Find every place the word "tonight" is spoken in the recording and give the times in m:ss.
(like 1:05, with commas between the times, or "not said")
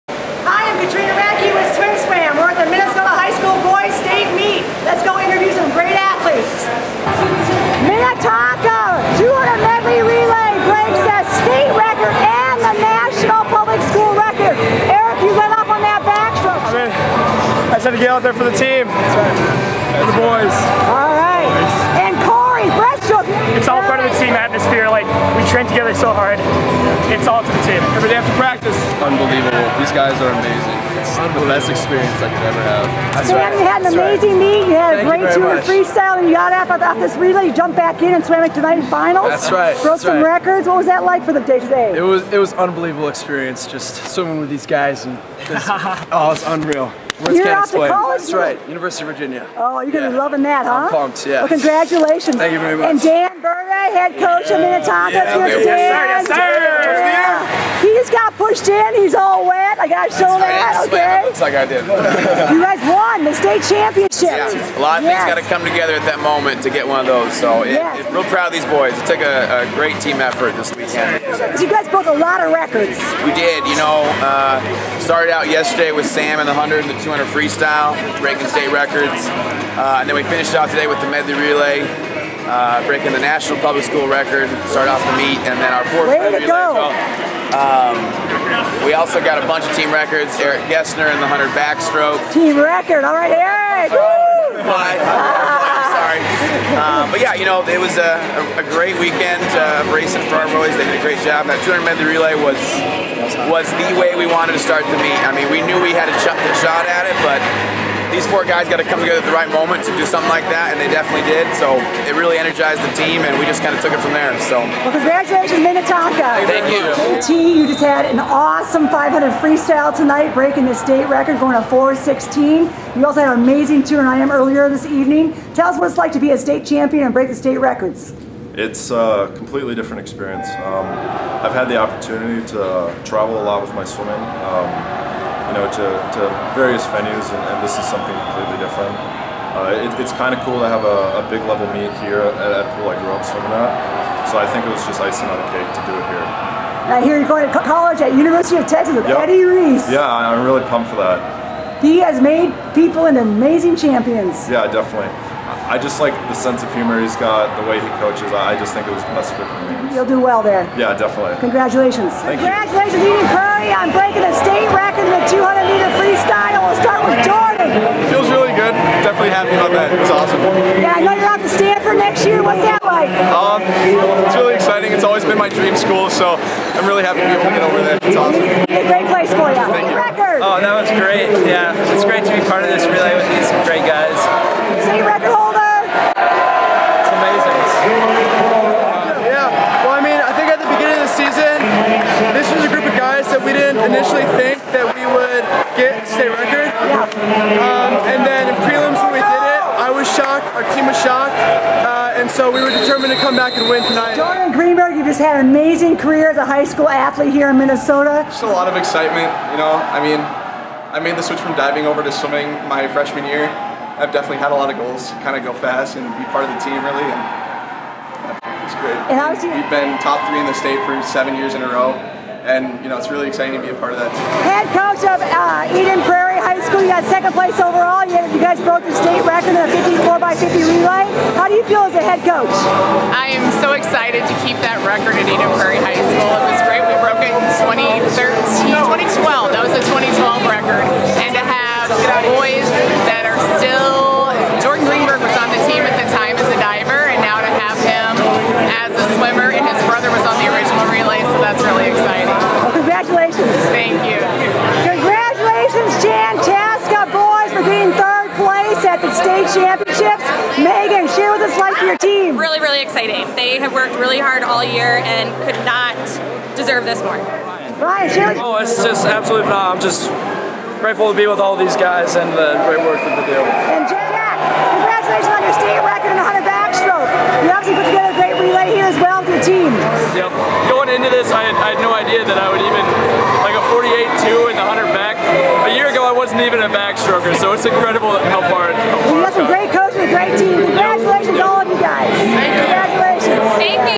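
1:59, 3:23.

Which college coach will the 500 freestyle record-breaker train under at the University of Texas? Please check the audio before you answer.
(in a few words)
Eddie Reese.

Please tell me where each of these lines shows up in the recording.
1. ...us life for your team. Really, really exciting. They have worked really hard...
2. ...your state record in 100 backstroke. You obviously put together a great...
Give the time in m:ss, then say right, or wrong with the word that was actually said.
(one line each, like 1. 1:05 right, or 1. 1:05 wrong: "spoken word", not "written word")
1. 4:21 right
2. 4:35 right.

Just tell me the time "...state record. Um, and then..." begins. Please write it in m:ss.
3:16.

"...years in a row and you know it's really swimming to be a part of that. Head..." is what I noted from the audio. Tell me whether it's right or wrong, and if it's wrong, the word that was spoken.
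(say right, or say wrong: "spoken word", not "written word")
wrong: "exciting", not "swimming".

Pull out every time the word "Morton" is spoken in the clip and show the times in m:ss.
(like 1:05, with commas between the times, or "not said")
not said.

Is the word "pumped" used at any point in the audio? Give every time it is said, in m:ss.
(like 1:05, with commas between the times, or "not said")
0:50, 2:30.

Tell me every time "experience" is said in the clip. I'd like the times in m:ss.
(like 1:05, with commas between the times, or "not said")
0:31, 0:43, 2:10.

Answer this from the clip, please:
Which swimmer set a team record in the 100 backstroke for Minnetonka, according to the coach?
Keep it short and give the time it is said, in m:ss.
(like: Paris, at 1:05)
Eric Gessner, at 1:30.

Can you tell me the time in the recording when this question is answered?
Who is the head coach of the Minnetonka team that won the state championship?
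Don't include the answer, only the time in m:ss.
0:53.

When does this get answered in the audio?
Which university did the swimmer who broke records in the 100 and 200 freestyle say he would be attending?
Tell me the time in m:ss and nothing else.
0:48.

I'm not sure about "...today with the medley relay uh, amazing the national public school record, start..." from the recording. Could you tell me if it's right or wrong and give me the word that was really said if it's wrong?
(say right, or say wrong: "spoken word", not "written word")
wrong: "breaking", not "amazing".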